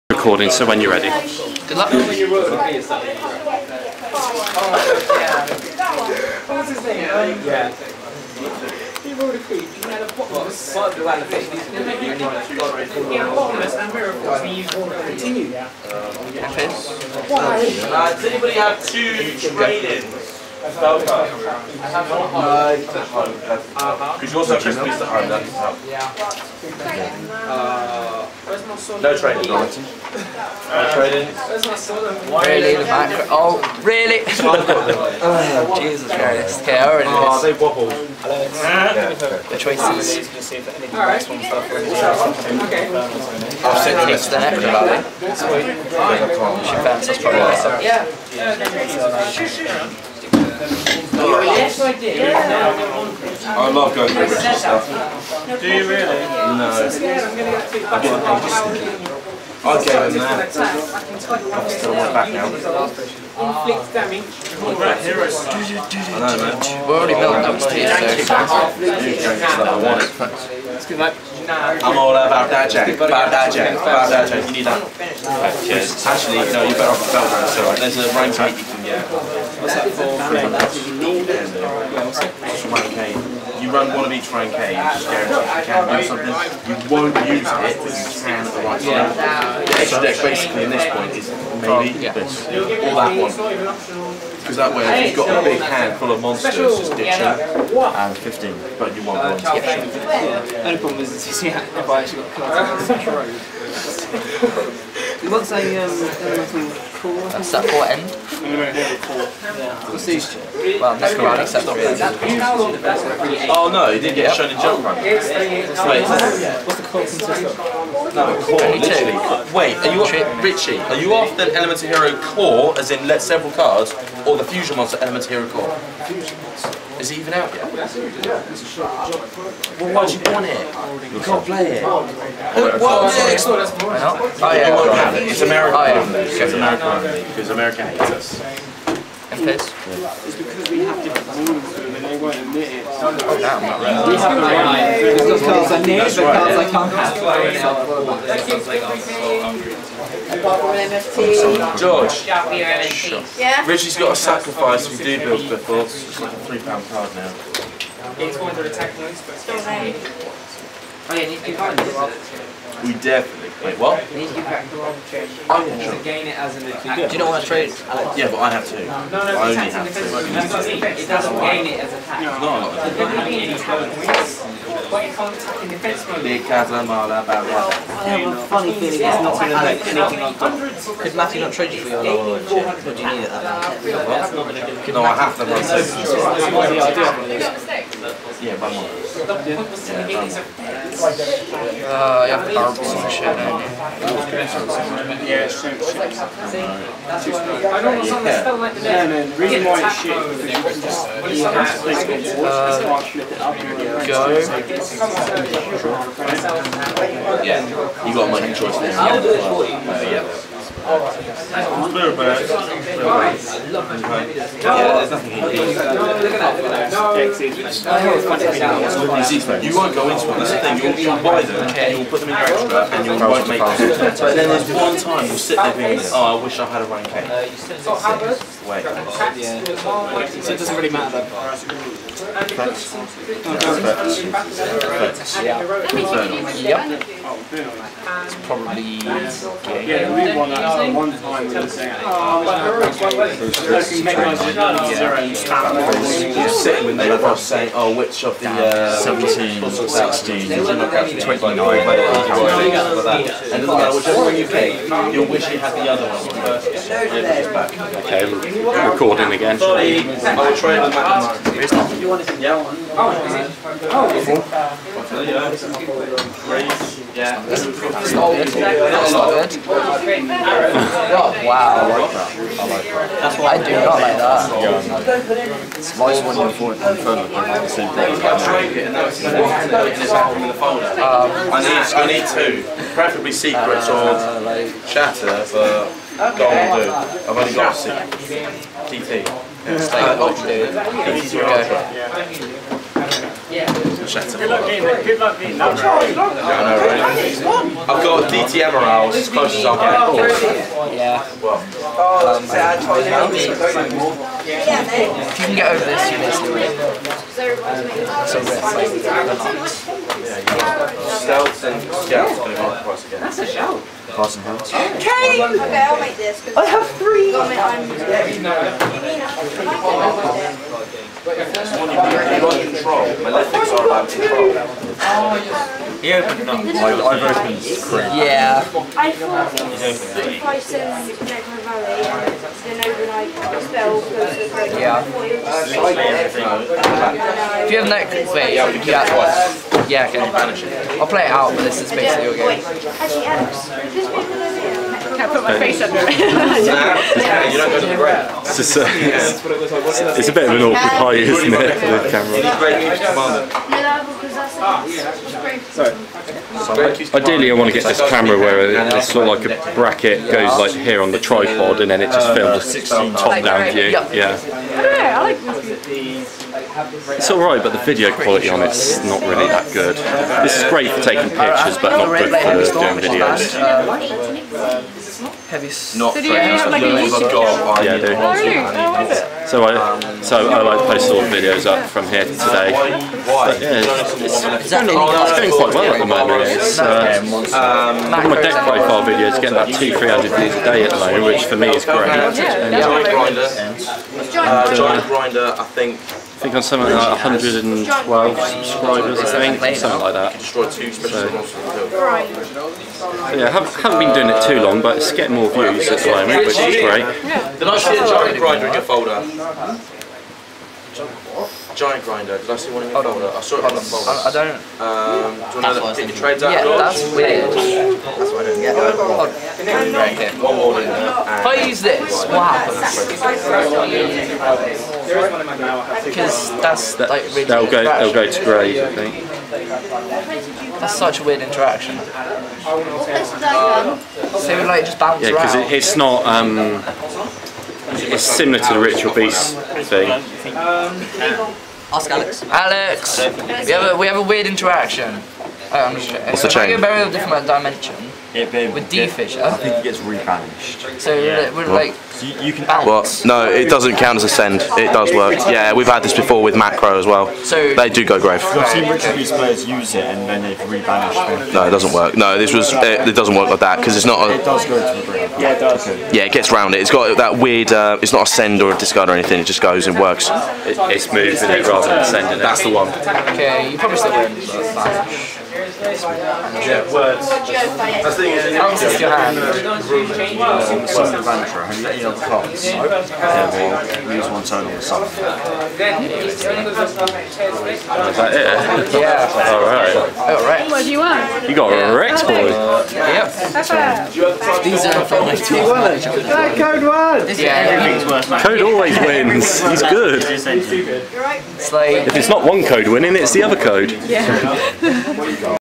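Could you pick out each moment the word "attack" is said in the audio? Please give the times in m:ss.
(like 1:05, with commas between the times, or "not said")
2:46, 2:51.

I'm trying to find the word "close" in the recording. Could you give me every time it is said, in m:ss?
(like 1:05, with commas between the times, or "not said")
4:59.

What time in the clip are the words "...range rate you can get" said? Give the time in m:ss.
1:18.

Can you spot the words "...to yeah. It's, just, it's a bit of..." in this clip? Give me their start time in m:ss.
5:47.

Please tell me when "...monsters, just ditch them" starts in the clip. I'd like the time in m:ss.
1:36.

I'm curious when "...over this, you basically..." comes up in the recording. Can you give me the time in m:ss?
5:05.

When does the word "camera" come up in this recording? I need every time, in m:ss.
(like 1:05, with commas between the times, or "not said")
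5:52, 5:58.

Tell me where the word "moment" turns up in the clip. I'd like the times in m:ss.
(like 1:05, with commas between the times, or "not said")
6:26, 6:30, 6:46.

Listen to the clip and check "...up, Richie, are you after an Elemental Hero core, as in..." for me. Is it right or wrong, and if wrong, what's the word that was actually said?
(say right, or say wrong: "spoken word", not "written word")
right.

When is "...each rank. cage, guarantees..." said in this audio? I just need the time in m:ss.
1:24.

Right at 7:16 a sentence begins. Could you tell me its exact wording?
Um, it's similar to the ritual Beast thing.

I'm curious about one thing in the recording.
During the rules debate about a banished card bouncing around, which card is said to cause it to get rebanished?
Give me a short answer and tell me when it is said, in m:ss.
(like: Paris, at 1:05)
D-Fissure, at 7:28.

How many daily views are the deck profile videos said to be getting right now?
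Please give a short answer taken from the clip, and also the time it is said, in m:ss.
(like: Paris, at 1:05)
200-300, at 6:29.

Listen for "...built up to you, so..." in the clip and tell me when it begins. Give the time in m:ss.
1:07.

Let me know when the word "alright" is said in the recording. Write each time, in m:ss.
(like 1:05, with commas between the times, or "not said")
0:40, 6:07, 8:09.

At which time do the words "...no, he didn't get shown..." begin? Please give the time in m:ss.
1:53.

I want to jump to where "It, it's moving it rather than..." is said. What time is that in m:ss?
7:50.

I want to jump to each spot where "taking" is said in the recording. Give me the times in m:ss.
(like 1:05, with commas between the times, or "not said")
6:11.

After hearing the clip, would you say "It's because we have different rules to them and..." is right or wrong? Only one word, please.
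right.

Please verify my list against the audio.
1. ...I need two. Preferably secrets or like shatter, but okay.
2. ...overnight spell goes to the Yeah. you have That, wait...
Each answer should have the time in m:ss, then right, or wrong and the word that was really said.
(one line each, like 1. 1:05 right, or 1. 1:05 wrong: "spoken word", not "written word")
1. 4:41 right
2. 5:32 wrong: "Netflix", not "That".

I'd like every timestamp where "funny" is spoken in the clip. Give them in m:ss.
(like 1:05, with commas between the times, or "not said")
2:58.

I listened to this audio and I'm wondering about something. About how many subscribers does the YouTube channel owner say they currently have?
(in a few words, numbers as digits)
112.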